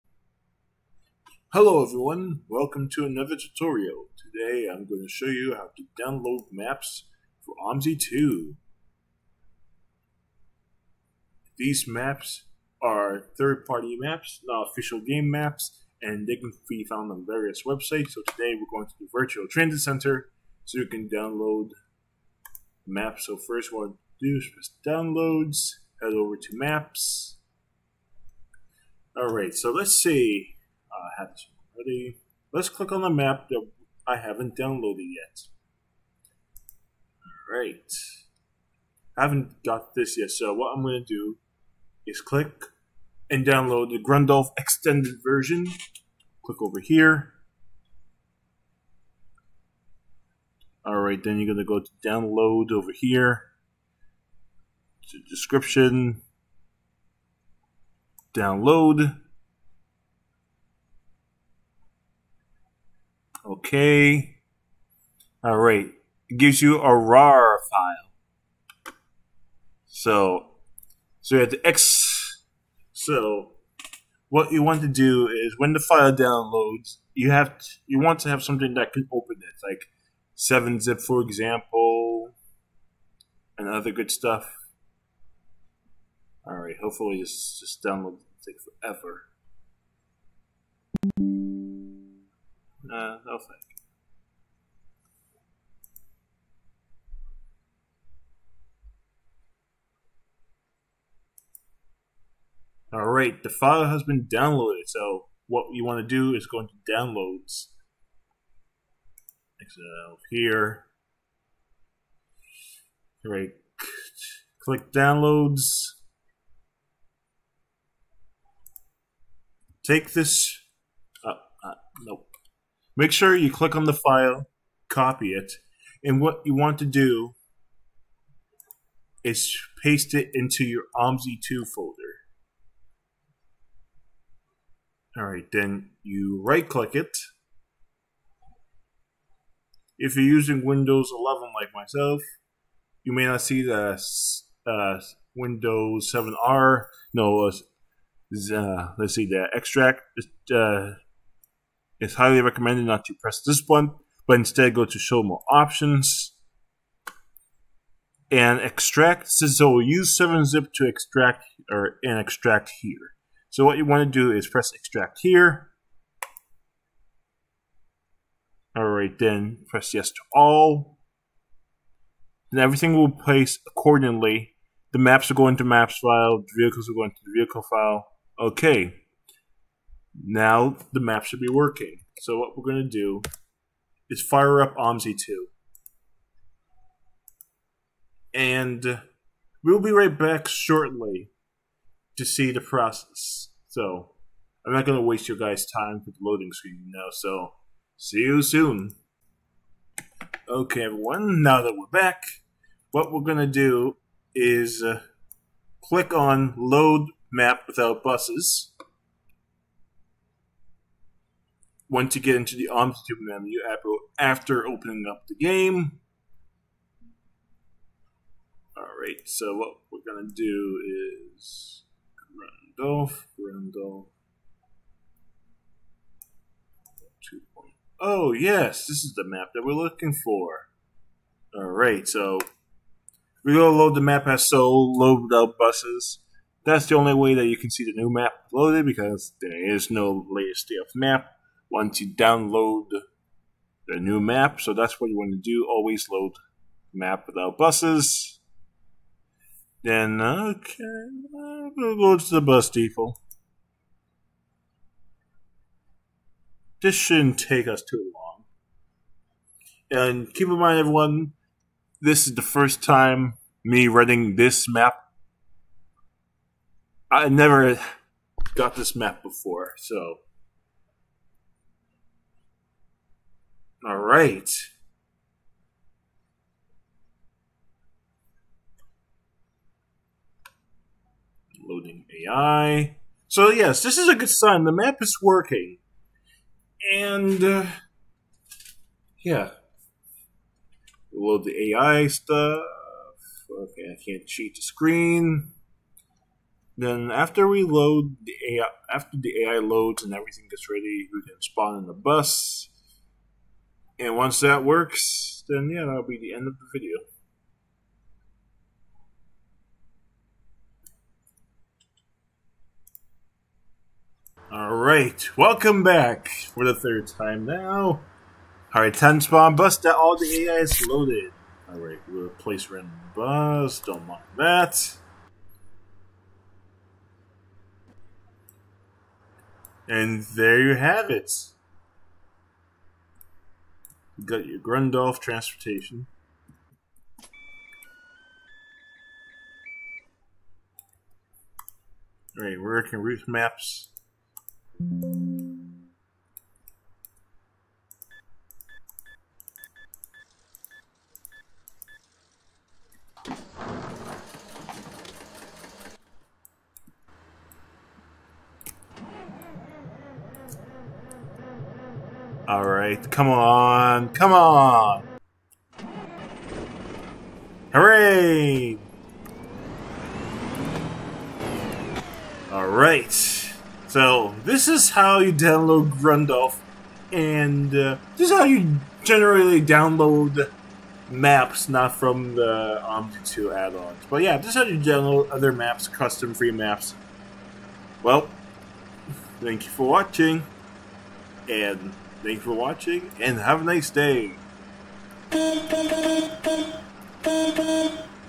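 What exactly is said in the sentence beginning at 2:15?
Alright, then you right click it.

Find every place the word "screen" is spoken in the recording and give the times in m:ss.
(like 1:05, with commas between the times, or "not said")
3:16, 4:54.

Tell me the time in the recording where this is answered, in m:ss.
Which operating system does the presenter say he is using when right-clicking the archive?
2:20.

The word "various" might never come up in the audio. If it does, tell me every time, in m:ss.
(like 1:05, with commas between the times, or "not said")
0:17.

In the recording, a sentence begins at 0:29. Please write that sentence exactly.
Alright, so let's see I have this already.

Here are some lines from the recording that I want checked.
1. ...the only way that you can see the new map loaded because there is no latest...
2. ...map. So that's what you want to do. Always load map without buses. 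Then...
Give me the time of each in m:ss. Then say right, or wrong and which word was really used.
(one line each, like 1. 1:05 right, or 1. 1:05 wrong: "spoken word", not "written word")
1. 3:56 right
2. 4:04 right.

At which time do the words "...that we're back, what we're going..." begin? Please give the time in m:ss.
3:21.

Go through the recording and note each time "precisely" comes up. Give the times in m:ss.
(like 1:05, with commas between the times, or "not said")
not said.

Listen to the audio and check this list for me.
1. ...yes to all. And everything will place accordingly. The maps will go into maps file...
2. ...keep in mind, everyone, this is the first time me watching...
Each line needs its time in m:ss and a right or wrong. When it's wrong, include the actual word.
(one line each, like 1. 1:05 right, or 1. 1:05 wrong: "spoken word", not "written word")
1. 2:49 right
2. 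4:20 wrong: "running", not "watching".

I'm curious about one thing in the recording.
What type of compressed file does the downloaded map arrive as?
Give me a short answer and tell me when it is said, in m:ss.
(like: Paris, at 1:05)
RAR file, at 1:06.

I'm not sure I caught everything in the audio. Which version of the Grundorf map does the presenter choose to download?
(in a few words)
extended version.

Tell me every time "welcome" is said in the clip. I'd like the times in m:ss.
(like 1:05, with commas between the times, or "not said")
0:02, 5:15.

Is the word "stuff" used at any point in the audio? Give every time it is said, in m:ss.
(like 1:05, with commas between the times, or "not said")
1:24, 4:52.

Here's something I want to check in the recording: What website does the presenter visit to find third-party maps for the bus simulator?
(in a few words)
Virtual Transit Center.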